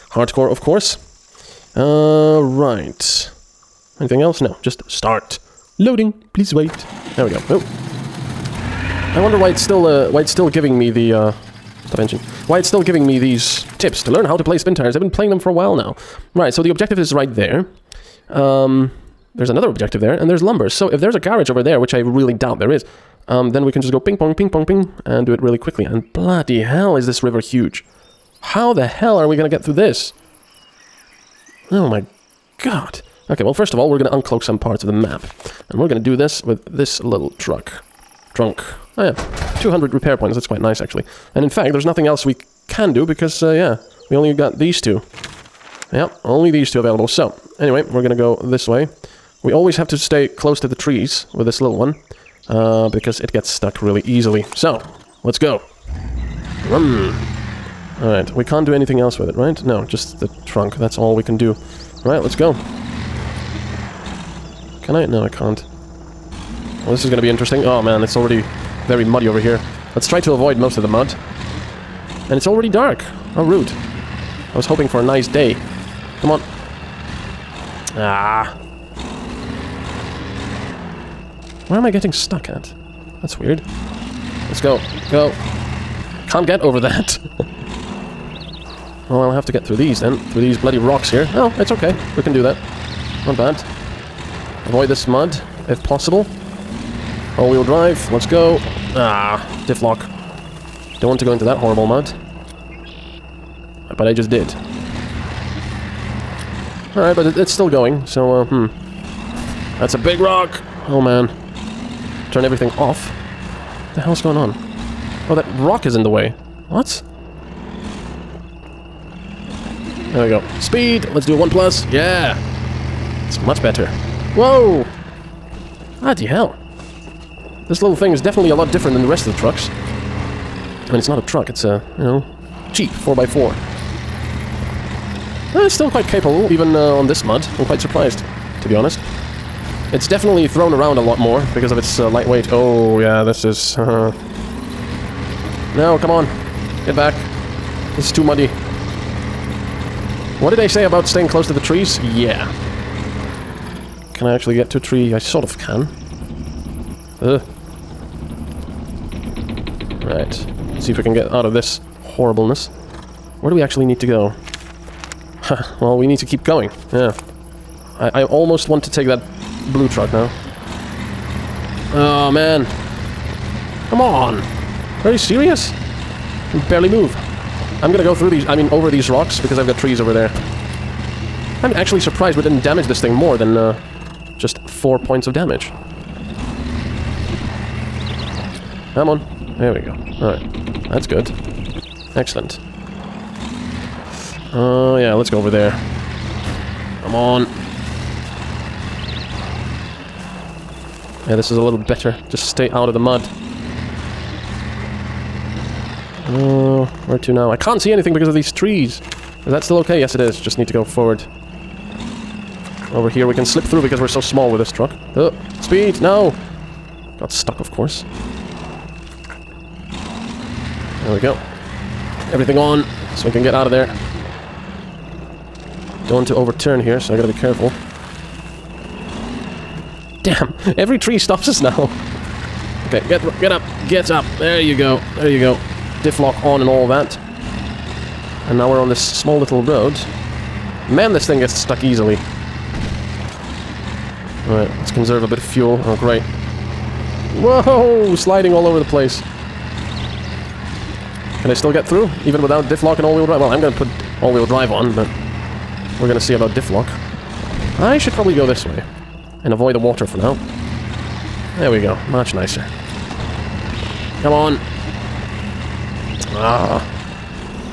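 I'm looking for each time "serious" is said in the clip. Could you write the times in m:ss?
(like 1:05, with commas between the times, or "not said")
2:55.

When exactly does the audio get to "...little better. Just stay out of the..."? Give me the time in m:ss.
3:21.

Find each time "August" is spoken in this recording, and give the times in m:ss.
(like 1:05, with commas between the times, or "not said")
not said.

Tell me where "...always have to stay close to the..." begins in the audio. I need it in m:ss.
0:49.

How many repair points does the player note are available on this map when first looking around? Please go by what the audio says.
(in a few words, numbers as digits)
200.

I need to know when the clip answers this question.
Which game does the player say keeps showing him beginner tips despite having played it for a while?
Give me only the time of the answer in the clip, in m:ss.
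0:14.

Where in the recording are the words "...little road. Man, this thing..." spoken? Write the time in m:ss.
3:59.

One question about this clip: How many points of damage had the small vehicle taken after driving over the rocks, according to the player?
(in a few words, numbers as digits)
4.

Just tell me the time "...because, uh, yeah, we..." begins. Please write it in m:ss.
0:43.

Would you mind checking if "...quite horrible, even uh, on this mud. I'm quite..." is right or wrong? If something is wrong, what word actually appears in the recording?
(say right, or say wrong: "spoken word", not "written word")
wrong: "capable", not "horrible".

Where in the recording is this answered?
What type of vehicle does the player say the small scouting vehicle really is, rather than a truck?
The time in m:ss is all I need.
2:12.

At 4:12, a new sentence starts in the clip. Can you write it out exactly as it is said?
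Even without diff lock and all-wheel drive?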